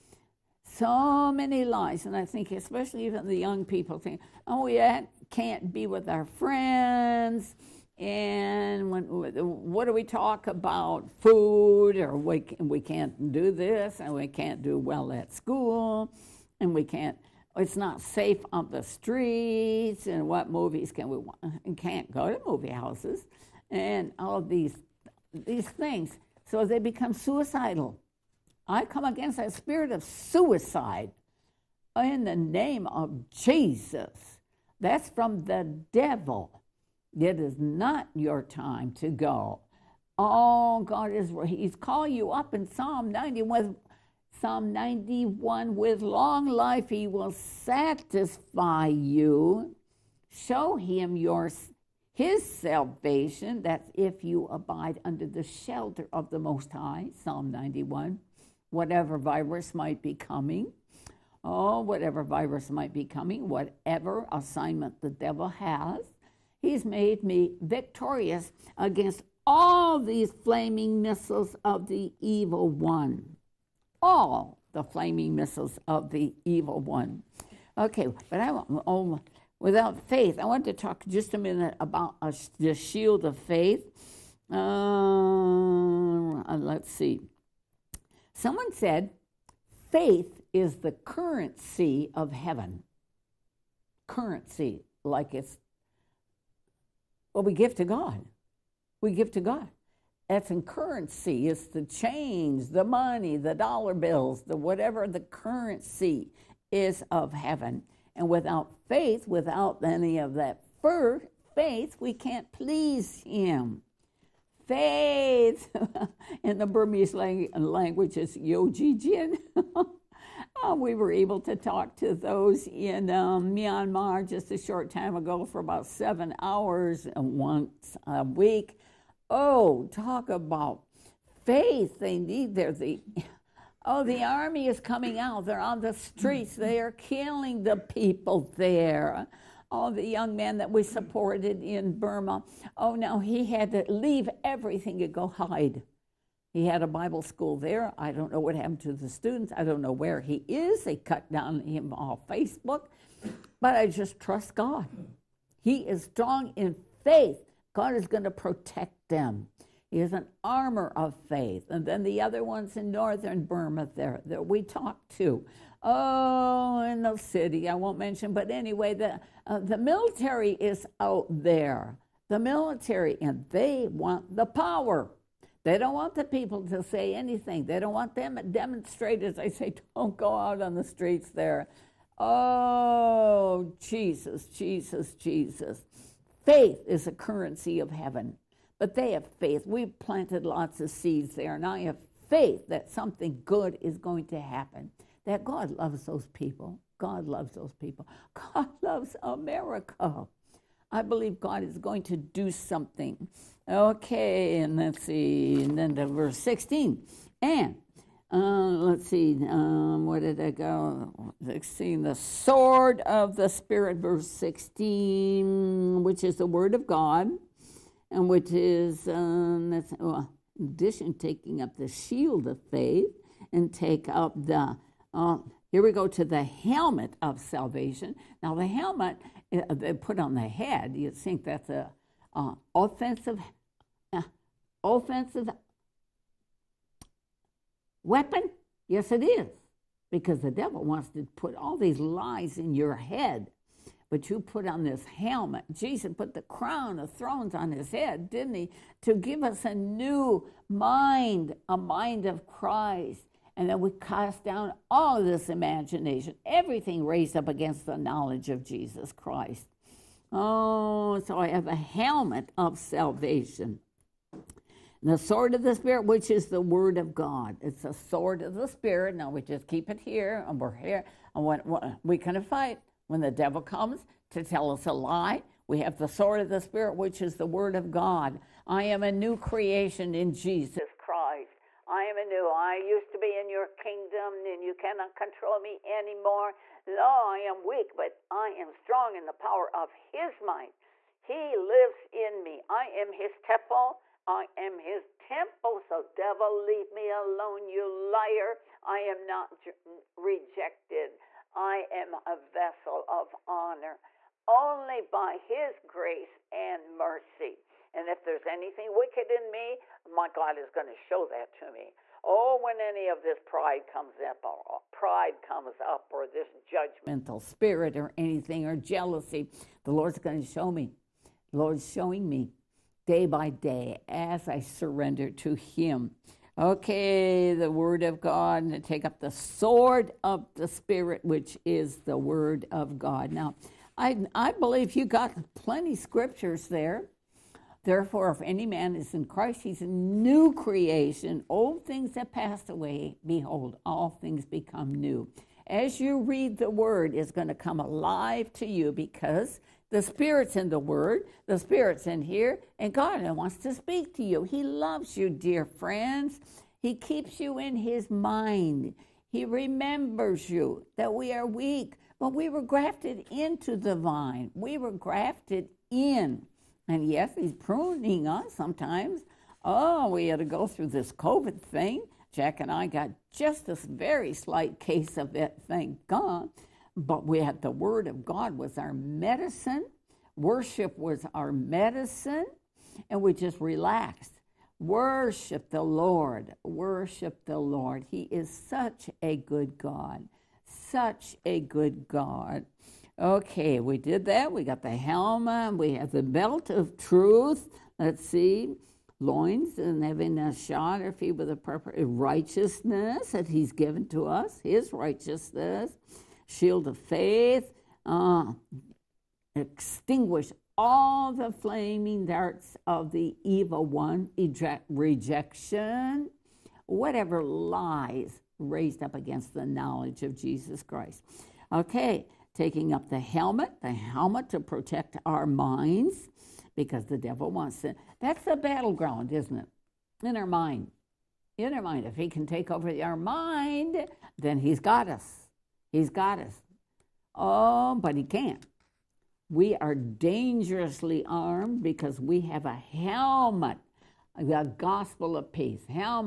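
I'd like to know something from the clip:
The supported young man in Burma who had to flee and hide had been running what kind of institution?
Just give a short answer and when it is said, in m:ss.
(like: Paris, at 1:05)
Bible school, at 2:26.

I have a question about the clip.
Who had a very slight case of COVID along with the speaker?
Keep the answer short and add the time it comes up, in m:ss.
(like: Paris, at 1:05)
Jack, at 6:12.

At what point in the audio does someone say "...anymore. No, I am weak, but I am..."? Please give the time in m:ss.
4:45.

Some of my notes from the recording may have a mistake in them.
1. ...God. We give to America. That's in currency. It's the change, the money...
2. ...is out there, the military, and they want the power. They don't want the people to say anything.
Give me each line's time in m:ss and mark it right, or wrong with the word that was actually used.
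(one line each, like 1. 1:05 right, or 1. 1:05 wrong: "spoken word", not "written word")
1. 1:37 wrong: "God", not "America"
2. 2:50 right.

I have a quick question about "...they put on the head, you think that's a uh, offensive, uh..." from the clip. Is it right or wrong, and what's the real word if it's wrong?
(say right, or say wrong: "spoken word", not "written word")
right.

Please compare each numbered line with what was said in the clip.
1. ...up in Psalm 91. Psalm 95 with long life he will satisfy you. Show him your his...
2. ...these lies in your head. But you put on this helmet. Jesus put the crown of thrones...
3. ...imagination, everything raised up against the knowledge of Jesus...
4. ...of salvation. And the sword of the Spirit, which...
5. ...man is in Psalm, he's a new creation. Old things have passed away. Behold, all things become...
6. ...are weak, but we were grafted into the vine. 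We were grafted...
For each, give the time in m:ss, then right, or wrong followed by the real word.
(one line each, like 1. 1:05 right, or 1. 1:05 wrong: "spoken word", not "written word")
1. 0:42 wrong: "91", not "95"
2. 4:01 right
3. 4:15 right
4. 4:22 right
5. 5:38 wrong: "Christ", not "Psalm"
6. 6:01 right.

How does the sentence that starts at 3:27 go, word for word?
And uh, let's see, um, where did I go?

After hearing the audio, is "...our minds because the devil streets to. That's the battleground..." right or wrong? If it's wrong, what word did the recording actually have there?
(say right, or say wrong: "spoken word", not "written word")
wrong: "wants", not "streets".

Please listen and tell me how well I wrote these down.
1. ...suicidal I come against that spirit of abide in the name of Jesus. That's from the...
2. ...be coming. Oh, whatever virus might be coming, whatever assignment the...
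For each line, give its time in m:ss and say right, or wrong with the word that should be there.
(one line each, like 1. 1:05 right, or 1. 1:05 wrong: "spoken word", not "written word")
1. 0:27 wrong: "suicide", not "abide"
2. 1:00 right.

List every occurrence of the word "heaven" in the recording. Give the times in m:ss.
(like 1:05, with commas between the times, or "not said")
1:32, 1:47, 3:07.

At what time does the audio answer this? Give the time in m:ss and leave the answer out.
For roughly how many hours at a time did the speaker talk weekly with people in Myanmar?
2:05.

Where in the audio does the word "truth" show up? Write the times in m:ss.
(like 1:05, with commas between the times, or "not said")
6:36.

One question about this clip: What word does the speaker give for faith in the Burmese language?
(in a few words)
Yojijin.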